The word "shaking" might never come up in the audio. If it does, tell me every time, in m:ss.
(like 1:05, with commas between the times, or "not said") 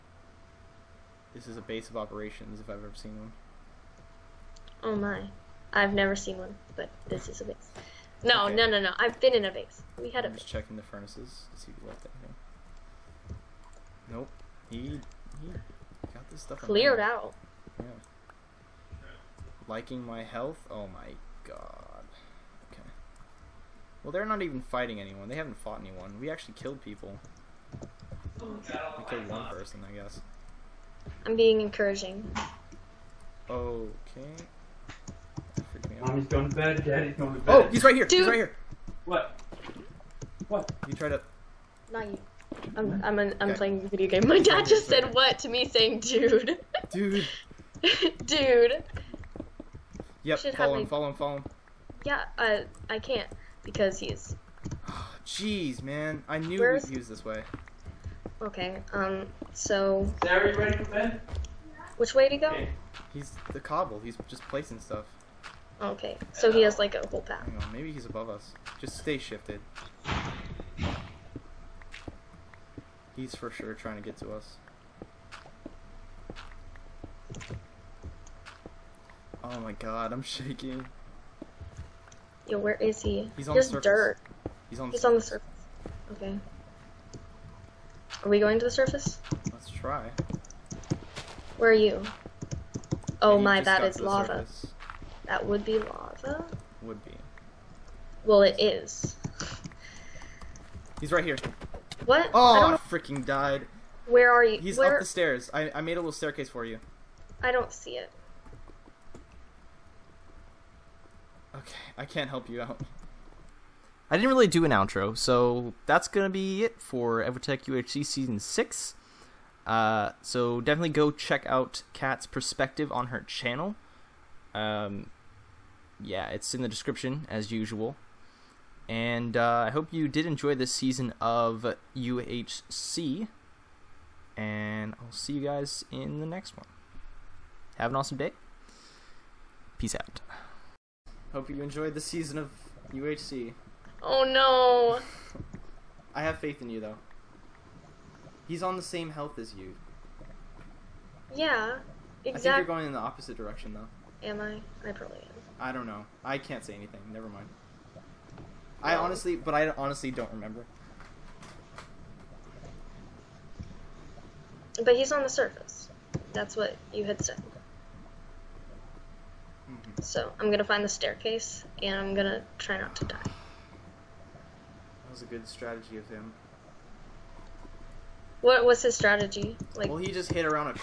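1:20.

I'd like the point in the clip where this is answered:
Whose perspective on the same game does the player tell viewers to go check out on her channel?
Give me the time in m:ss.
2:01.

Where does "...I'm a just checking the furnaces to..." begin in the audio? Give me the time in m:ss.
0:10.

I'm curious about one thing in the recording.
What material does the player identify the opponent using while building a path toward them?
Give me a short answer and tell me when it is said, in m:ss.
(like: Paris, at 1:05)
cobble, at 1:03.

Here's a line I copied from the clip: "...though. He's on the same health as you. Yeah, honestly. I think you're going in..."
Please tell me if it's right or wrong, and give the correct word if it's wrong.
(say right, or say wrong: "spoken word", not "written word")
wrong: "exactly", not "honestly".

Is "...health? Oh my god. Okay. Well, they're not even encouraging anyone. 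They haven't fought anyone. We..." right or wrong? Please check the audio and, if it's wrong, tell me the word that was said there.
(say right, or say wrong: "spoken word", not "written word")
wrong: "fighting", not "encouraging".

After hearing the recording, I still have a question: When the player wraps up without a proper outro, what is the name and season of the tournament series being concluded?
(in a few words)
EvoTech UHC Season 6.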